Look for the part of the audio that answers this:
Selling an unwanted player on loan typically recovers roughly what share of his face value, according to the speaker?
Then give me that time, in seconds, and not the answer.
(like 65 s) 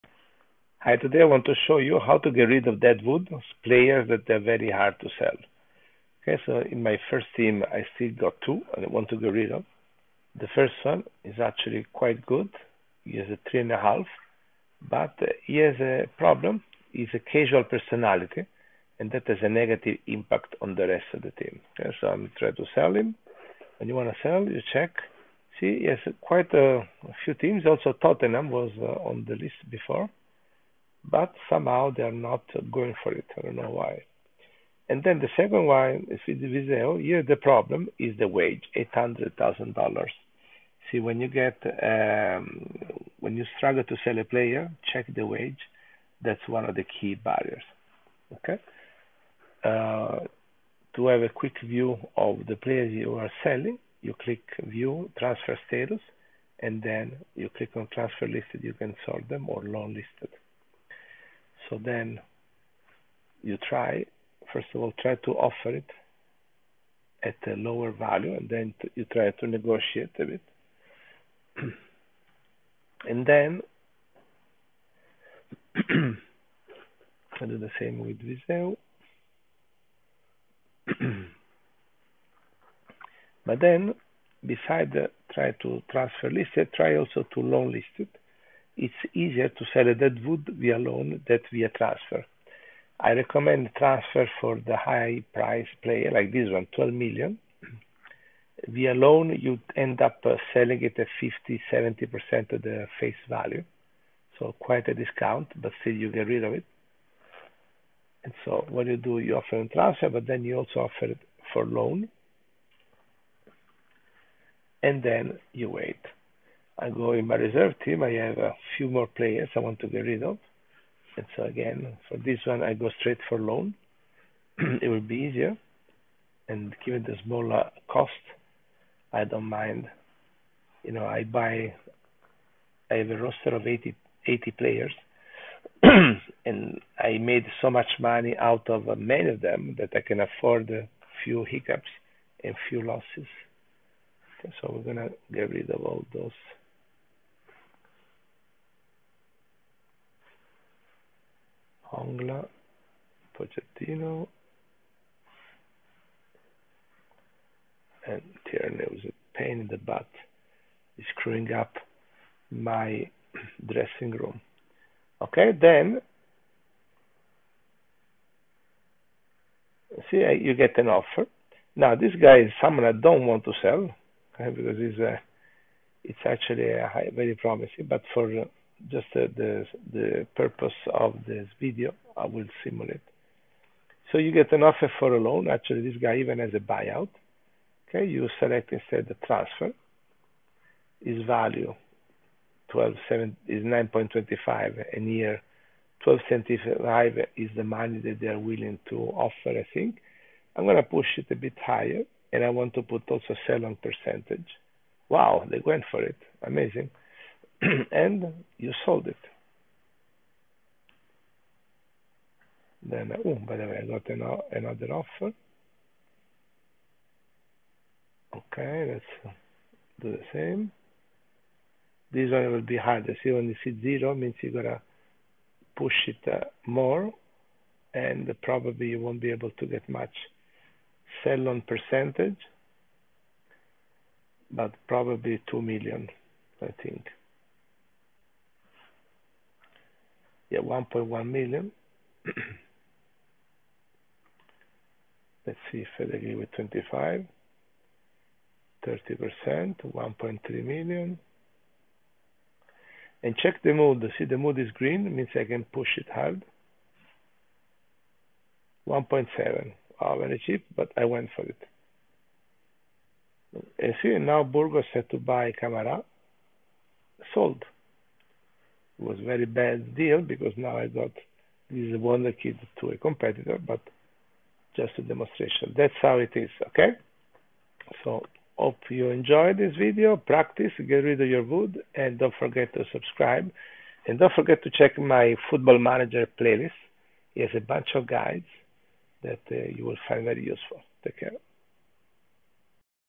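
101 s.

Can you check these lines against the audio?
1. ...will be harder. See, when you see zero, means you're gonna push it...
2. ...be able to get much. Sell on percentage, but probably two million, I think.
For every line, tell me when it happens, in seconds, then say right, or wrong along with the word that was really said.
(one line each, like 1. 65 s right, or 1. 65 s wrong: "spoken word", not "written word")
1. 222 s right
2. 229 s right.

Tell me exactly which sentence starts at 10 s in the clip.
The first one is actually quite good.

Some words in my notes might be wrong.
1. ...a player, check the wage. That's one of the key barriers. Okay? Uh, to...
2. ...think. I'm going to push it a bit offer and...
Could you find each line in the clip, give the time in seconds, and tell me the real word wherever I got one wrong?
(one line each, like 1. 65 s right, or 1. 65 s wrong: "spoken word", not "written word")
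1. 44 s right
2. 199 s wrong: "higher", not "offer".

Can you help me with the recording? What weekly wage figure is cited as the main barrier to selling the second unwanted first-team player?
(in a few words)
$800,000.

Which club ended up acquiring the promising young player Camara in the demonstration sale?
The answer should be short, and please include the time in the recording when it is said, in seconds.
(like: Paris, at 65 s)
Burgos, at 264 s.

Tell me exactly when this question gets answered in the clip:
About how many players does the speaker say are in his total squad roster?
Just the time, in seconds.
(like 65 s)
133 s.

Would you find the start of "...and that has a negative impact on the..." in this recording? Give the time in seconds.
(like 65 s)
18 s.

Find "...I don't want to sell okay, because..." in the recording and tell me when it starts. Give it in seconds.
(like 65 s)
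172 s.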